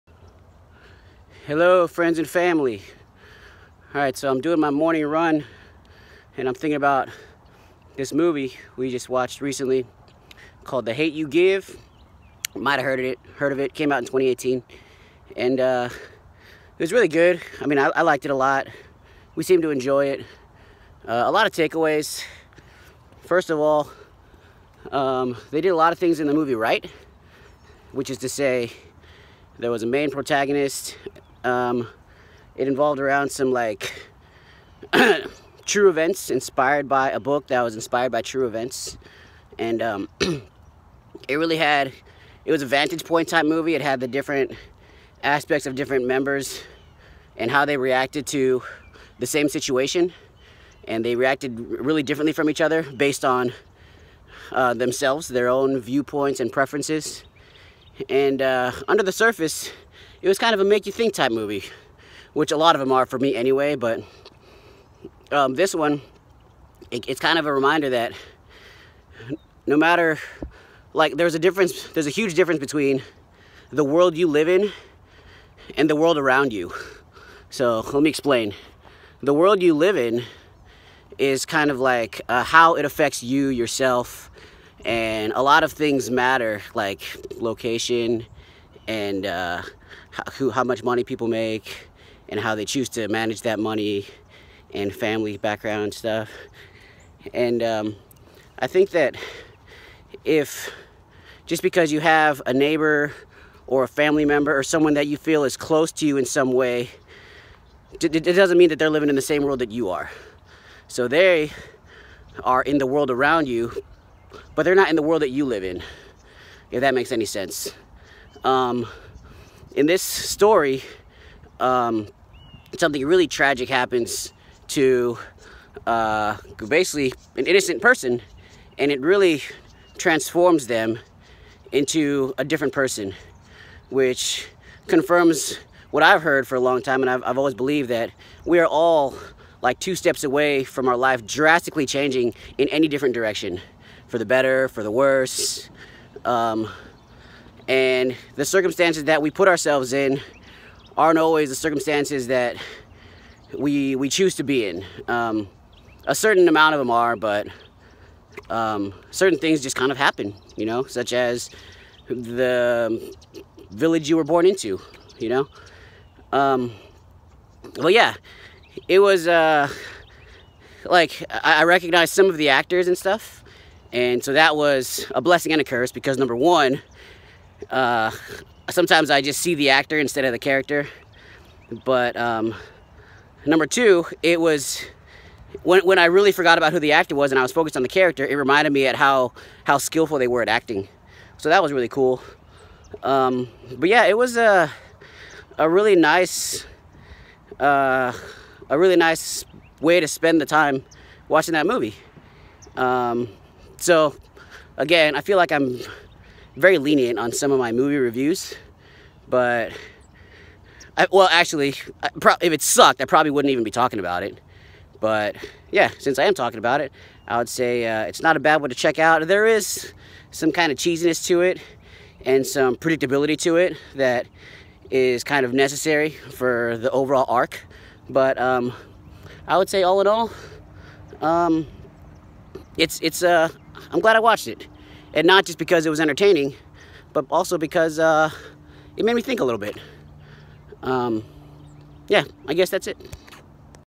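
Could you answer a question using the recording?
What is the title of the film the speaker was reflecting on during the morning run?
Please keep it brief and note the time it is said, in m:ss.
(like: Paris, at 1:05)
The Hate U Give, at 0:10.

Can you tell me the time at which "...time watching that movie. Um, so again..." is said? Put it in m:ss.
3:20.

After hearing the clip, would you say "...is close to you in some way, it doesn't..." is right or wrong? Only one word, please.
right.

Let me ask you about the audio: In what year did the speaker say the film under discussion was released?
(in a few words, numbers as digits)
2018.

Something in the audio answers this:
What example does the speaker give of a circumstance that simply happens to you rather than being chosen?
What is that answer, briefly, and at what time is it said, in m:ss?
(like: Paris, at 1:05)
the village you were born into, at 2:42.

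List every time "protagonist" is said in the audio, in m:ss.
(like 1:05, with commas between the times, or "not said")
0:30.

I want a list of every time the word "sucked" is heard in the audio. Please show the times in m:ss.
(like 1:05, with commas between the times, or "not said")
3:32.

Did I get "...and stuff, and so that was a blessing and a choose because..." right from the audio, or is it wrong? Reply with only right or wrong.
wrong.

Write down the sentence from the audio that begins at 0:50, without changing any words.
And they reacted really differently from each other based on uh, themselves, their own viewpoints and preferences.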